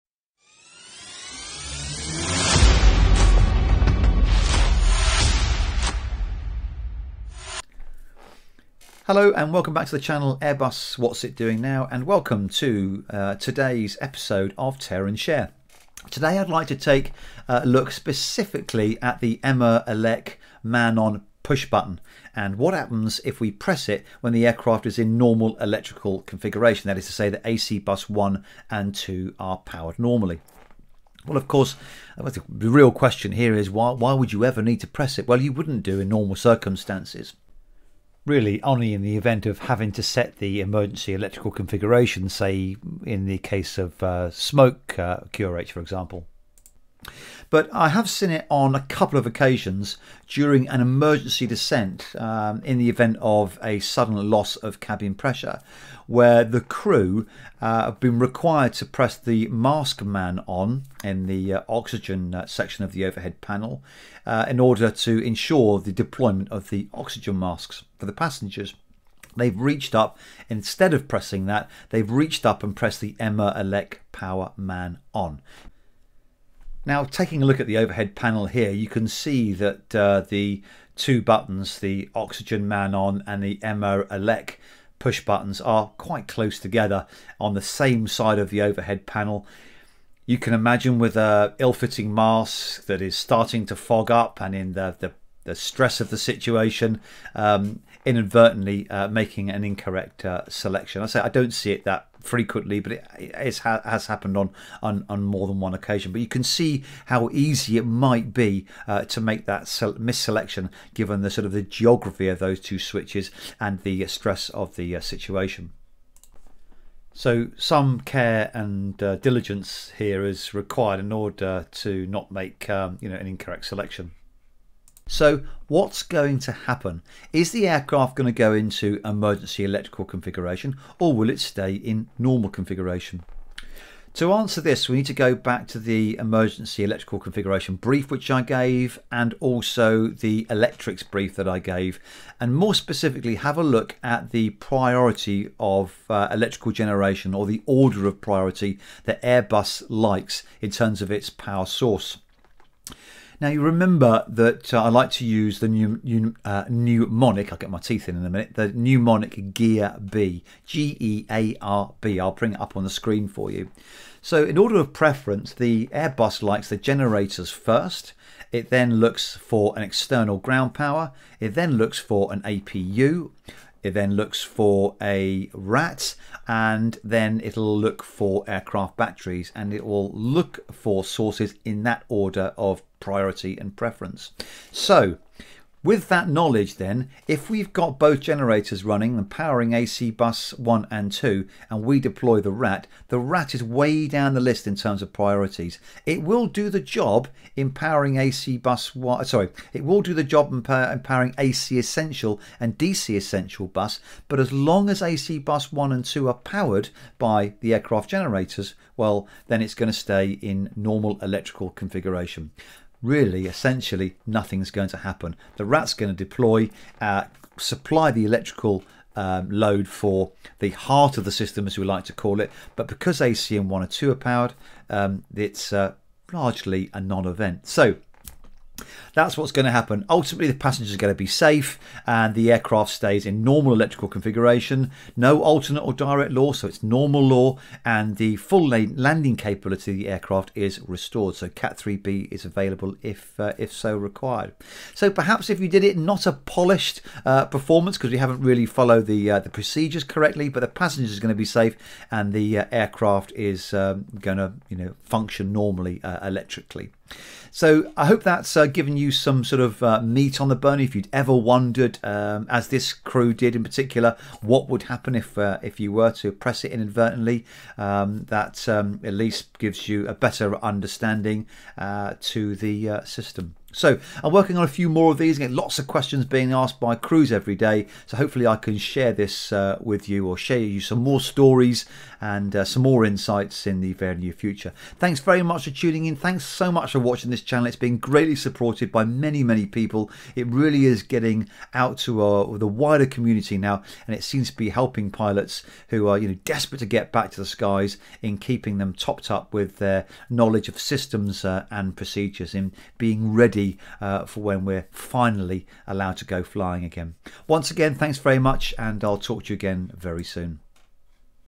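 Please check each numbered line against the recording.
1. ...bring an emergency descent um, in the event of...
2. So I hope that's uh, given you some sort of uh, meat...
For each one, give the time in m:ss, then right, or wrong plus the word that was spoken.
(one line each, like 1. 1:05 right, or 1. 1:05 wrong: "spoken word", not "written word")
1. 0:50 wrong: "during", not "bring"
2. 4:17 right.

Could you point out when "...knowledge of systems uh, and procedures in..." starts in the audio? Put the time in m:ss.
5:00.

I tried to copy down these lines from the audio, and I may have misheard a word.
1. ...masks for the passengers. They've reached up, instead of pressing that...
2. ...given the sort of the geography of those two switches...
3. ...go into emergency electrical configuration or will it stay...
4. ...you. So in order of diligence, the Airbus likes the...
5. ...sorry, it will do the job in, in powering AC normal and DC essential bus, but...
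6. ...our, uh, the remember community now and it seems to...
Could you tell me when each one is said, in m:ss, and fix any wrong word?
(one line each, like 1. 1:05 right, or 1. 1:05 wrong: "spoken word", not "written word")
1. 1:07 right
2. 1:50 right
3. 2:08 right
4. 2:43 wrong: "preference", not "diligence"
5. 3:19 wrong: "essential", not "normal"
6. 4:52 wrong: "wider", not "remember".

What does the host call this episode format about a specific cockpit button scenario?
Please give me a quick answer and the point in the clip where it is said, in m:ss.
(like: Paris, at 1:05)
Tear and Share, at 0:14.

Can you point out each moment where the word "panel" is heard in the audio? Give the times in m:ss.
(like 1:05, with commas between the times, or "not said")
1:03, 1:18, 1:29.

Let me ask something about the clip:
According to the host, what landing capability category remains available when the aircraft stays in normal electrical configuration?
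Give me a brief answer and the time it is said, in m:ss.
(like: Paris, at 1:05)
Cat 3B, at 4:01.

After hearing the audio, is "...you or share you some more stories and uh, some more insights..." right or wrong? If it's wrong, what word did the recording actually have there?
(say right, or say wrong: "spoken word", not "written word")
right.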